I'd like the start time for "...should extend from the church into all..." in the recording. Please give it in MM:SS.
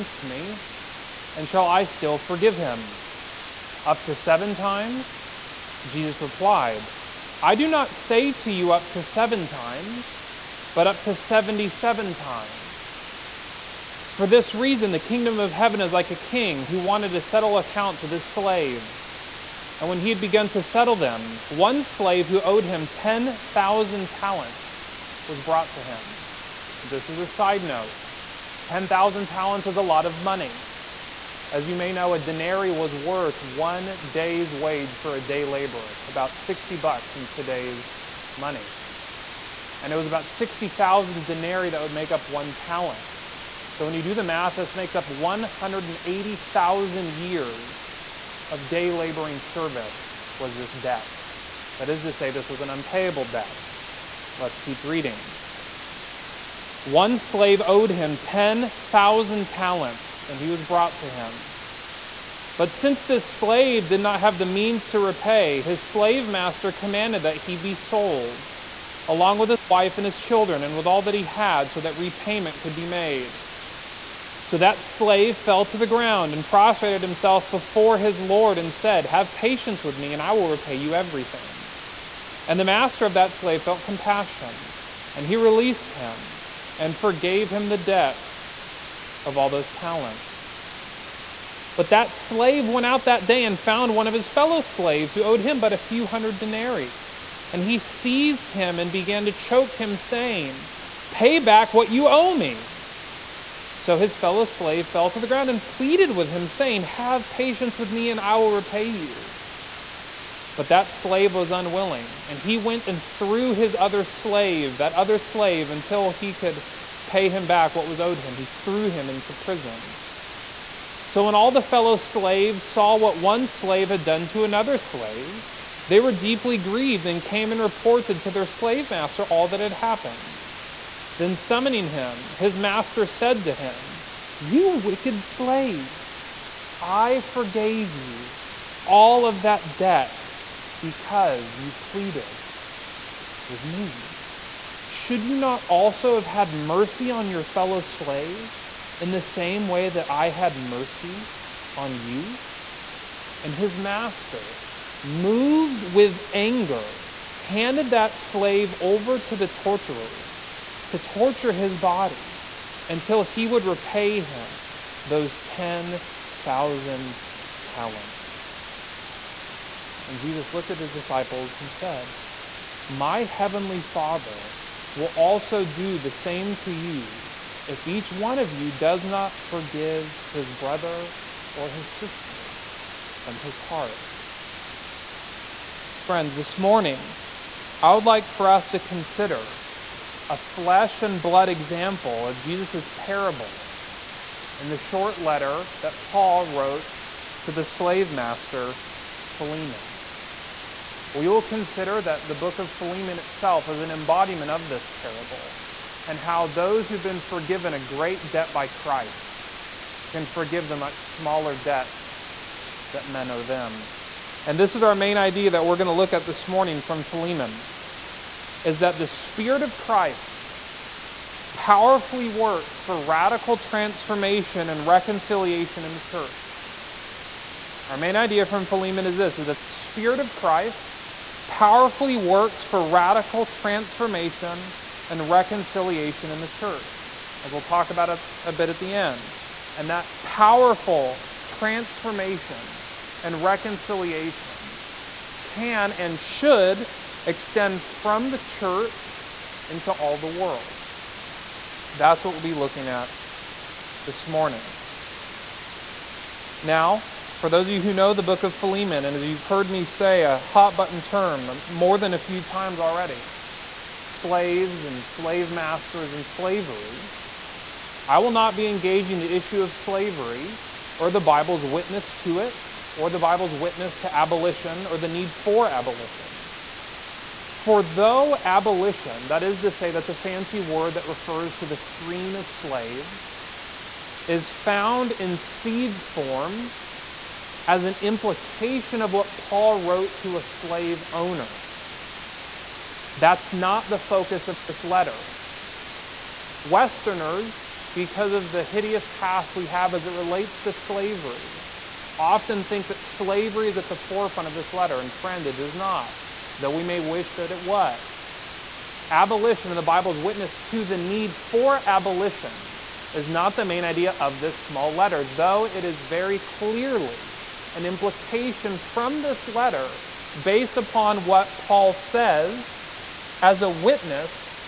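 04:06.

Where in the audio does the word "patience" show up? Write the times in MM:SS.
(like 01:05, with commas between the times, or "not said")
01:19, 01:47.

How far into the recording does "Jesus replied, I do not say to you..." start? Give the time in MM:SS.
00:05.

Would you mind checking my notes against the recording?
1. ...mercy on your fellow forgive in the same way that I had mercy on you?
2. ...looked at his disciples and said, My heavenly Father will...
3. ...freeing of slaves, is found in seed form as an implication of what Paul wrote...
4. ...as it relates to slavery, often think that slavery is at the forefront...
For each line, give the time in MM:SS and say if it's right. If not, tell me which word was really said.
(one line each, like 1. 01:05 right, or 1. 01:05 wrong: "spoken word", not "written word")
1. 02:26 wrong: "slave", not "forgive"
2. 02:50 right
3. 04:41 right
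4. 04:59 right.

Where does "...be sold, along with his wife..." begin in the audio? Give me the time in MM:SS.
01:07.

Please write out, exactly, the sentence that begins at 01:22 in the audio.
And the master of that slave felt compassion, and he released him and forgave him the debt of all those talents.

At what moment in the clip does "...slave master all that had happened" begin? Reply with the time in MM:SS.
02:08.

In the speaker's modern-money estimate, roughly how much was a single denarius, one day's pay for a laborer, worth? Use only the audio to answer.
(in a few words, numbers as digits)
$60.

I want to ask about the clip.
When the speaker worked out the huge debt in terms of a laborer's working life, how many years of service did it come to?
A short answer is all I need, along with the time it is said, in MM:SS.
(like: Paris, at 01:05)
180,000 years, at 00:45.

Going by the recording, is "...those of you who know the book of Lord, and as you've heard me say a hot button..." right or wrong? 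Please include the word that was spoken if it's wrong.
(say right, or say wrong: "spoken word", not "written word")
wrong: "Philemon", not "Lord".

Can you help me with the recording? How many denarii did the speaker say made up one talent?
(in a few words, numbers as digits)
60,000.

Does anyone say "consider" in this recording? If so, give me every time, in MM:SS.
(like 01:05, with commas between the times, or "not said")
03:08, 03:21.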